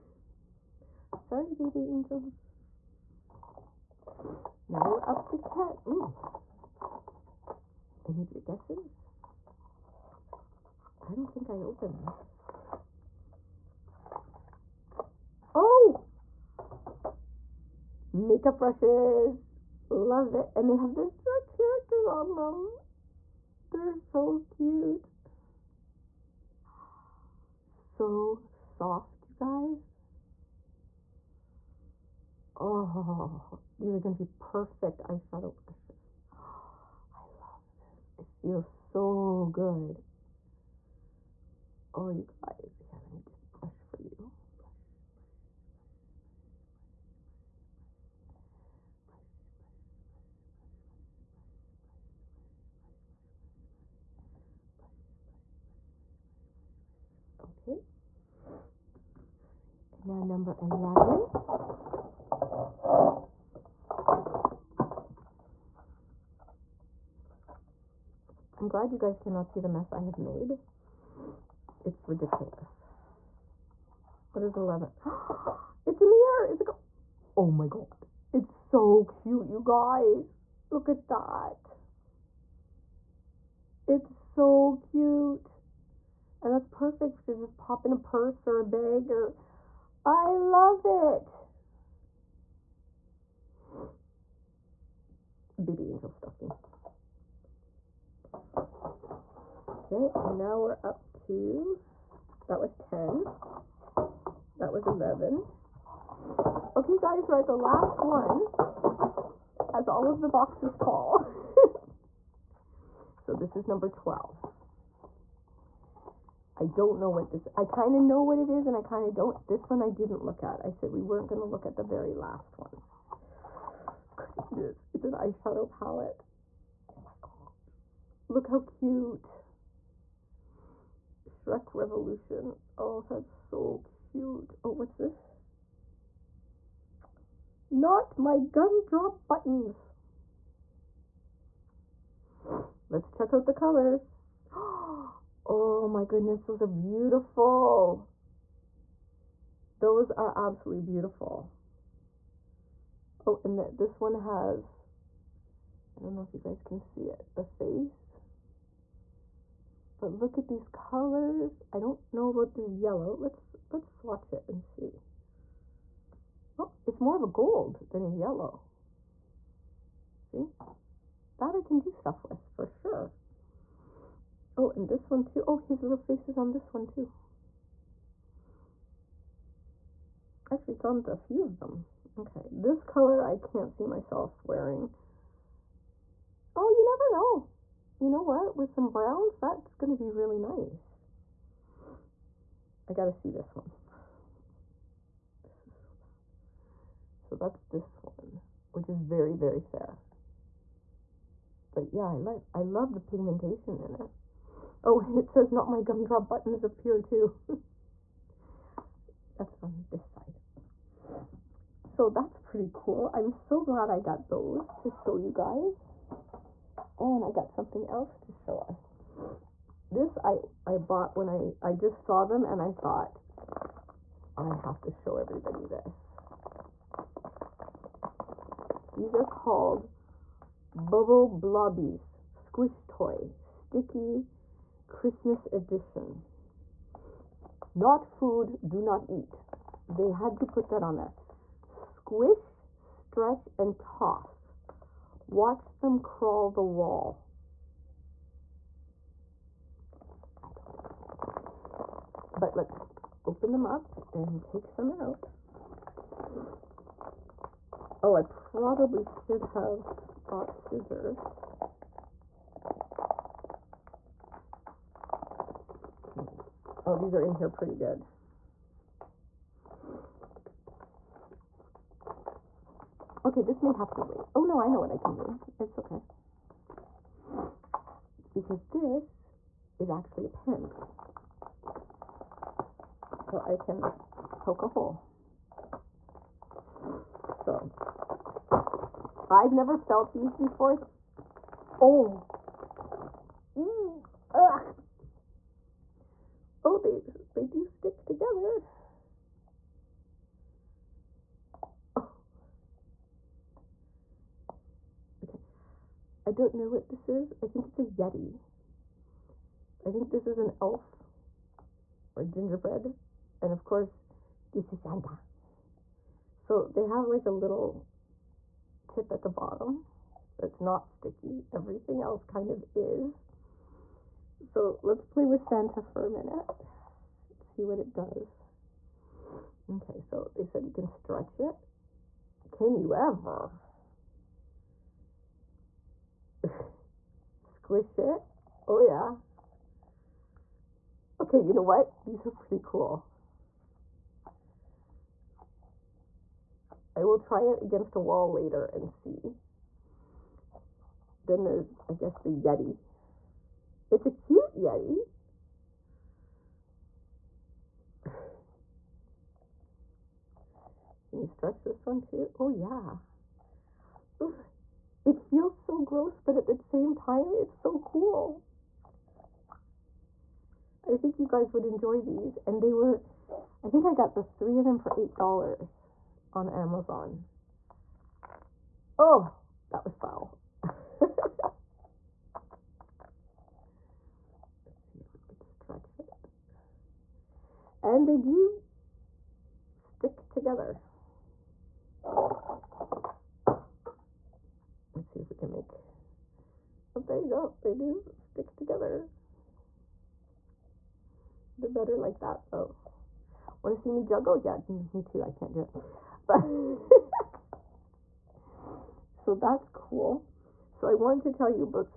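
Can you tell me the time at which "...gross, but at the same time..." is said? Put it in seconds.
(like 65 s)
365 s.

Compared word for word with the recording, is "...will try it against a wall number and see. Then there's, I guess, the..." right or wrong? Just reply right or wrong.
wrong.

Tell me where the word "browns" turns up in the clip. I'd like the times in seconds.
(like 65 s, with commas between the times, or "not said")
188 s.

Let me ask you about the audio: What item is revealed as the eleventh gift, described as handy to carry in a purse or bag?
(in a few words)
A mirror.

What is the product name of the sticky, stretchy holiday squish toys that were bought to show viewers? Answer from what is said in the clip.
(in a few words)
Bubble Blobbies.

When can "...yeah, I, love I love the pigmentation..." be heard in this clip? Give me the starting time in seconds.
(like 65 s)
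201 s.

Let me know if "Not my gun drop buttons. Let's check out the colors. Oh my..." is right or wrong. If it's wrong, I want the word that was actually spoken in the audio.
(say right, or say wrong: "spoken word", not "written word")
right.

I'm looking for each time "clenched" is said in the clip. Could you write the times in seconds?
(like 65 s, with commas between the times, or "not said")
not said.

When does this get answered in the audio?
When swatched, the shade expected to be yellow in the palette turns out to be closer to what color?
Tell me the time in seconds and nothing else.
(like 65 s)
167 s.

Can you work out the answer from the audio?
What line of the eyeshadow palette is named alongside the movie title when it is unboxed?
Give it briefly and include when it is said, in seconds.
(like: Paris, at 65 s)
Revolution, at 131 s.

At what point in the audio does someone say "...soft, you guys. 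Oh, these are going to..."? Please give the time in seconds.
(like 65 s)
28 s.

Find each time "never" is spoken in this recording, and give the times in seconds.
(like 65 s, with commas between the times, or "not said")
186 s, 289 s.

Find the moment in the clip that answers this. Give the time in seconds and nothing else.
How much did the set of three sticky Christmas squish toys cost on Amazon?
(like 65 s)
374 s.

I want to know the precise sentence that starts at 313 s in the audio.
And of course, this is Santa.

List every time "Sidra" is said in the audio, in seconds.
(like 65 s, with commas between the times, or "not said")
not said.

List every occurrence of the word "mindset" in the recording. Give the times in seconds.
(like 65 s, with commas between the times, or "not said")
not said.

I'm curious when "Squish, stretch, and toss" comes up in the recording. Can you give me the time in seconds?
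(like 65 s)
241 s.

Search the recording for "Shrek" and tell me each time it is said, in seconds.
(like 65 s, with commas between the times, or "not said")
21 s, 131 s.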